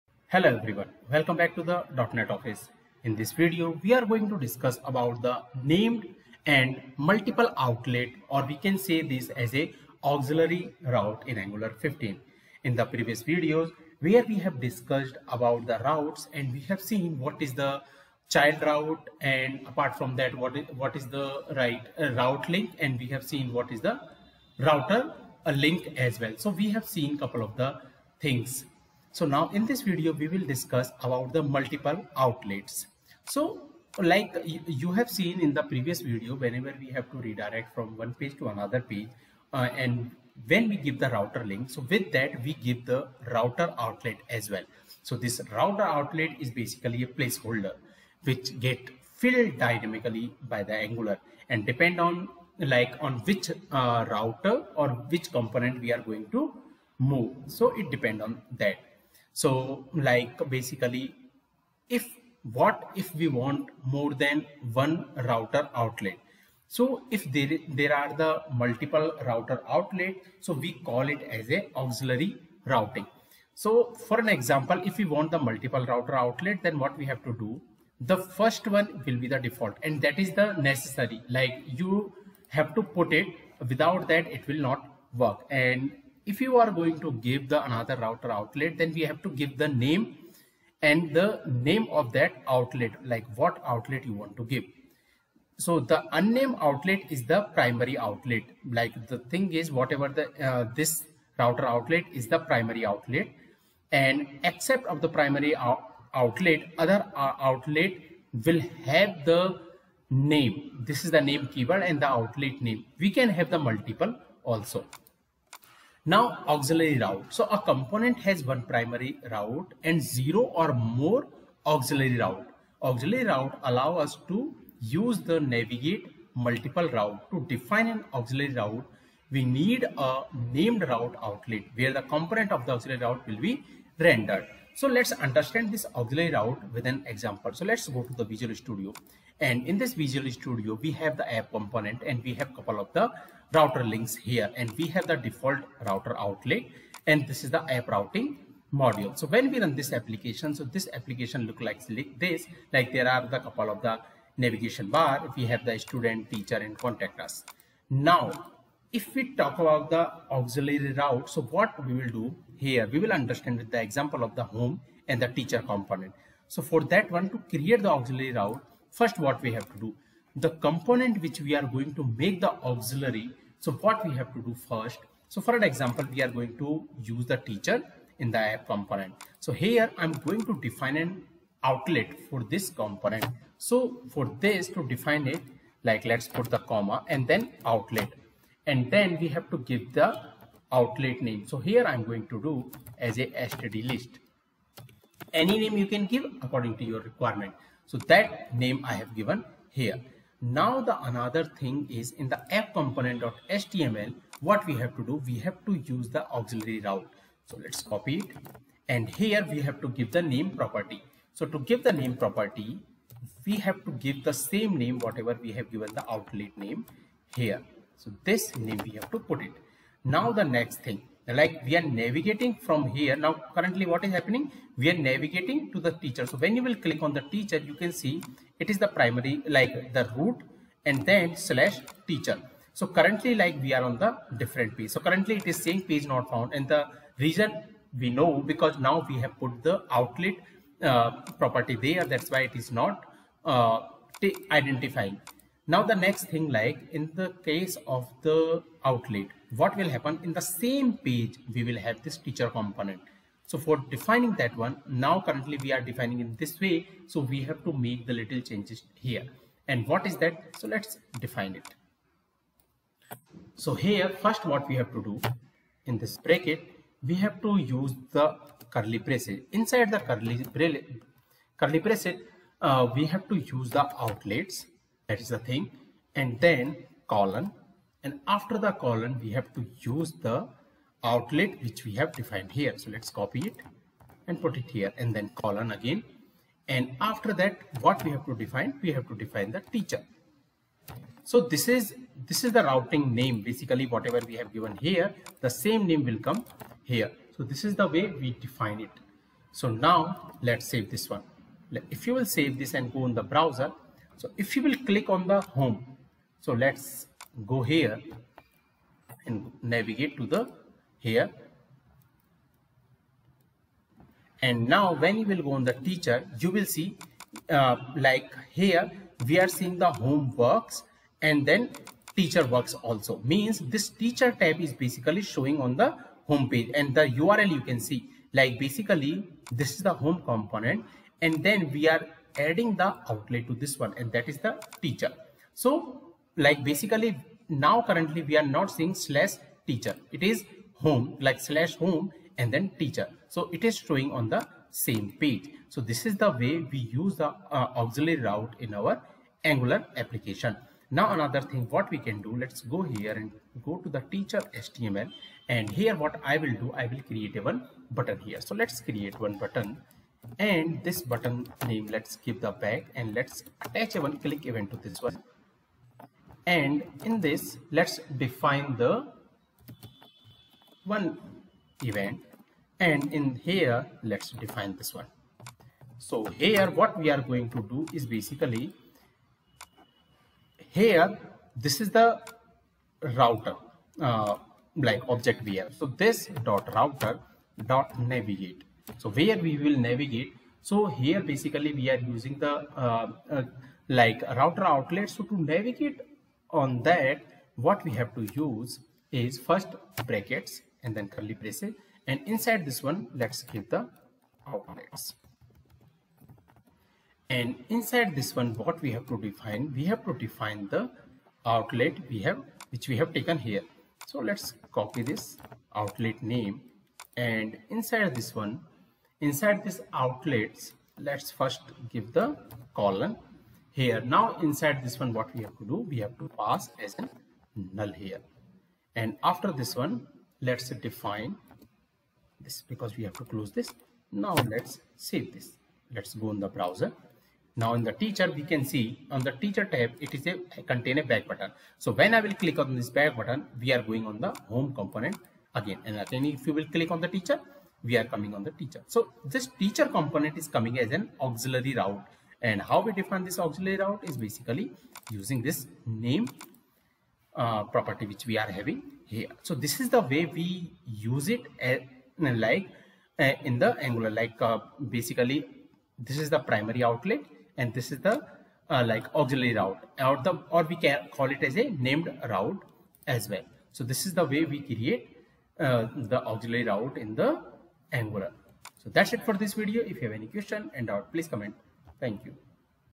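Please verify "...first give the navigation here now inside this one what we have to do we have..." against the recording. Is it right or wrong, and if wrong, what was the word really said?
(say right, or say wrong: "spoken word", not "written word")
wrong: "colon", not "navigation".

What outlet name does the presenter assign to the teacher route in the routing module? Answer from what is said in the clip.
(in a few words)
std list.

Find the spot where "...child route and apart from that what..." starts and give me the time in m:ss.
0:18.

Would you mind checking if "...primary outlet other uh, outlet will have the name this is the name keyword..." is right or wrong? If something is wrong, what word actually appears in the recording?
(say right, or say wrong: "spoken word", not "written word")
right.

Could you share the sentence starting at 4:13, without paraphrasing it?
So for defining that one, now currently we are defining it this way.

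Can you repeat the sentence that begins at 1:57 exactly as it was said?
So a component has one primary route and zero or more auxiliary route.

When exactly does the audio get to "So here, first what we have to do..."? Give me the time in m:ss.
4:23.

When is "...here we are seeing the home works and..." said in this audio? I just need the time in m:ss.
5:18.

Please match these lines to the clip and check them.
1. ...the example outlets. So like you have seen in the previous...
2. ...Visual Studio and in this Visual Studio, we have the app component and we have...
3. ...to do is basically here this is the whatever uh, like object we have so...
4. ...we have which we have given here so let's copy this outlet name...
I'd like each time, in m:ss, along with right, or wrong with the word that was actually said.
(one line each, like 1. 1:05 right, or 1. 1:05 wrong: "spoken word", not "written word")
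1. 0:31 wrong: "multiple", not "example"
2. 2:18 right
3. 6:17 wrong: "router", not "whatever"
4. 6:52 wrong: "taken", not "given".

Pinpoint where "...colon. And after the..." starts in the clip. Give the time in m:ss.
4:37.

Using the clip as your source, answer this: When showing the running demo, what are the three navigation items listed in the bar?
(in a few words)
student, teacher and contact us.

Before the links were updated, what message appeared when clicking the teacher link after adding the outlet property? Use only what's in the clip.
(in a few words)
page not found.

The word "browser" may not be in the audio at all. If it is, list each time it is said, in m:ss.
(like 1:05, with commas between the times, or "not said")
5:03, 7:16.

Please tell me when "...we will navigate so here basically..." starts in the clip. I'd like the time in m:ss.
6:29.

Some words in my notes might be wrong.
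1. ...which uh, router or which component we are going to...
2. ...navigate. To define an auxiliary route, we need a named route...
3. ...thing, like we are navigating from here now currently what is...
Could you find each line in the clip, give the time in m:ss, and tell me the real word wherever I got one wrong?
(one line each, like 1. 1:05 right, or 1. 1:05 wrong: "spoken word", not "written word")
1. 0:53 right
2. 2:06 wrong: "route", not "navigate"
3. 3:40 right.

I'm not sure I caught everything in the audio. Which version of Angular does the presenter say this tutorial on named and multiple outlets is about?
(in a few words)
Angular 15.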